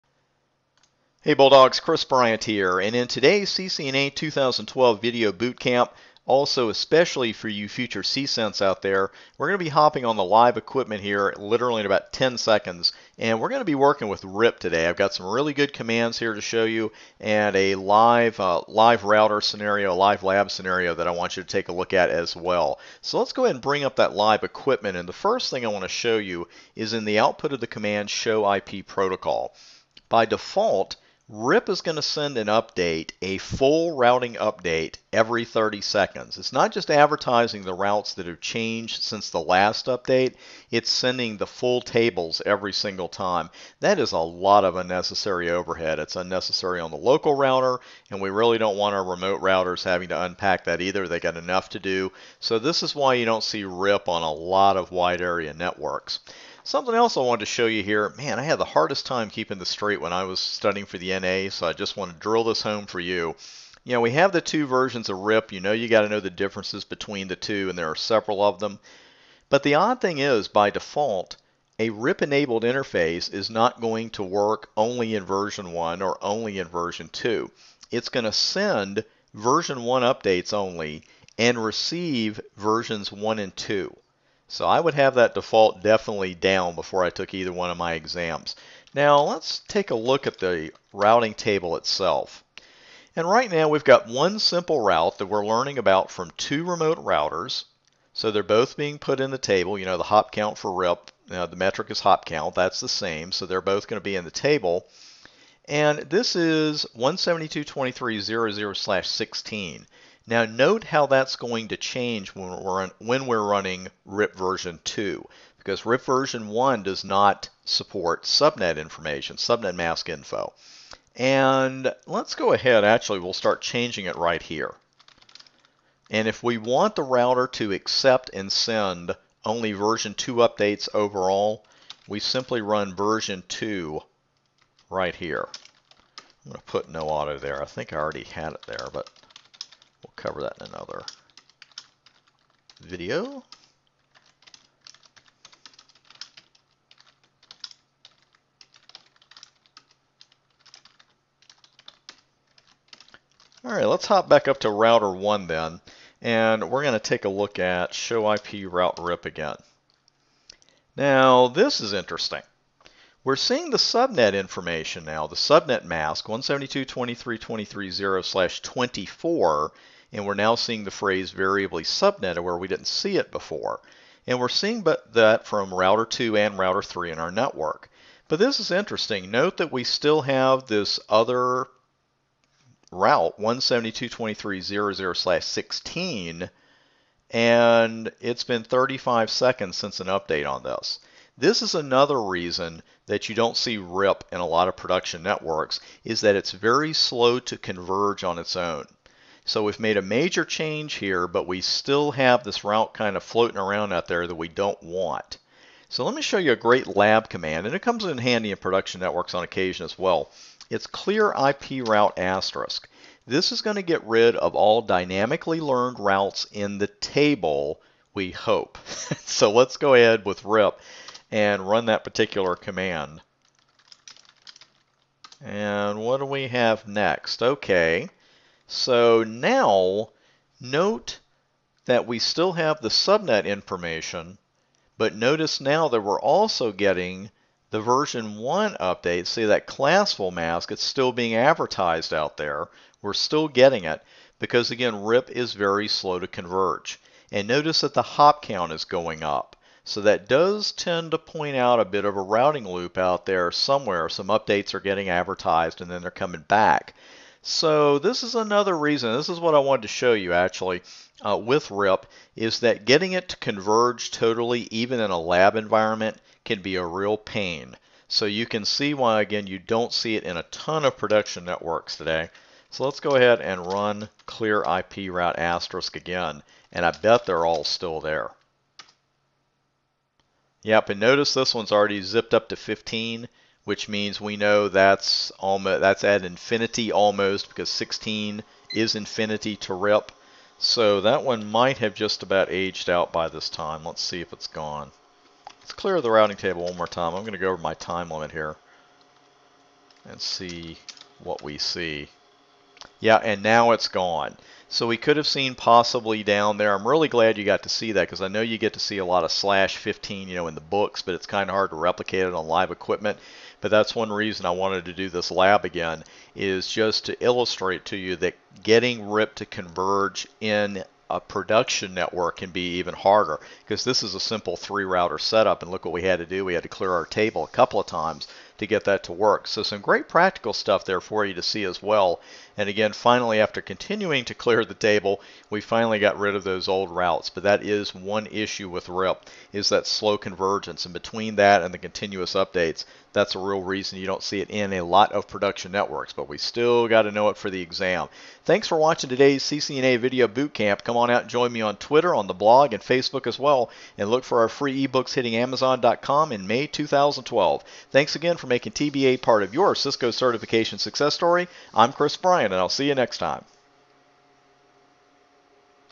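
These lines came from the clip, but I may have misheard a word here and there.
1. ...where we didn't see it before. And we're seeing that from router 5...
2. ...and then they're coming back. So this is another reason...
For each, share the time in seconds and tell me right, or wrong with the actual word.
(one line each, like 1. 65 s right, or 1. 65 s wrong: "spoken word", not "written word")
1. 172 s wrong: "2", not "5"
2. 255 s right.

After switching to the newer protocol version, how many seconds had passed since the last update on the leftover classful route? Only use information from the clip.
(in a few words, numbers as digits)
35.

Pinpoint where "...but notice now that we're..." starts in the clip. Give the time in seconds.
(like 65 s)
234 s.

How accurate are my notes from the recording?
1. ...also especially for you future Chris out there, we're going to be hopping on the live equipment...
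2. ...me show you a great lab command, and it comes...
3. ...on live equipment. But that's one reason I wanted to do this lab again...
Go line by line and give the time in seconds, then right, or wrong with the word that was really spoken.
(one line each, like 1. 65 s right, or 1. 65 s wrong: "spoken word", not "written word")
1. 6 s wrong: "CCENTs", not "Chris"
2. 206 s right
3. 312 s right.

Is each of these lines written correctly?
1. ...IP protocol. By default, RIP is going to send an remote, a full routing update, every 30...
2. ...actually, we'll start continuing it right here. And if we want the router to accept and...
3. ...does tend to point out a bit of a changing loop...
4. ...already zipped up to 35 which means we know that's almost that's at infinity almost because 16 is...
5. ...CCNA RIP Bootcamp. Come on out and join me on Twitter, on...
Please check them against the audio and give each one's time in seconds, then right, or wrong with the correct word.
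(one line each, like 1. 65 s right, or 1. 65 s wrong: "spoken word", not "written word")
1. 28 s wrong: "update", not "remote"
2. 122 s wrong: "changing", not "continuing"
3. 250 s wrong: "routing", not "changing"
4. 281 s wrong: "15", not "35"
5. 349 s wrong: "Video", not "RIP".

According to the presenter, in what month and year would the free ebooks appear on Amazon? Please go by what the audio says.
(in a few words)
May 2012.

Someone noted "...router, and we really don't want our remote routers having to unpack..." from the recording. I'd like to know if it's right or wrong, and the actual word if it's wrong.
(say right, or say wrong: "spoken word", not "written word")
right.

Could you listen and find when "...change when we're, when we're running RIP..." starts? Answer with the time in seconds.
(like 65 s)
111 s.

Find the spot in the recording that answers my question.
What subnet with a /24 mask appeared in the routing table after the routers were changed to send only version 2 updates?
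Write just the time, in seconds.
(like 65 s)
166 s.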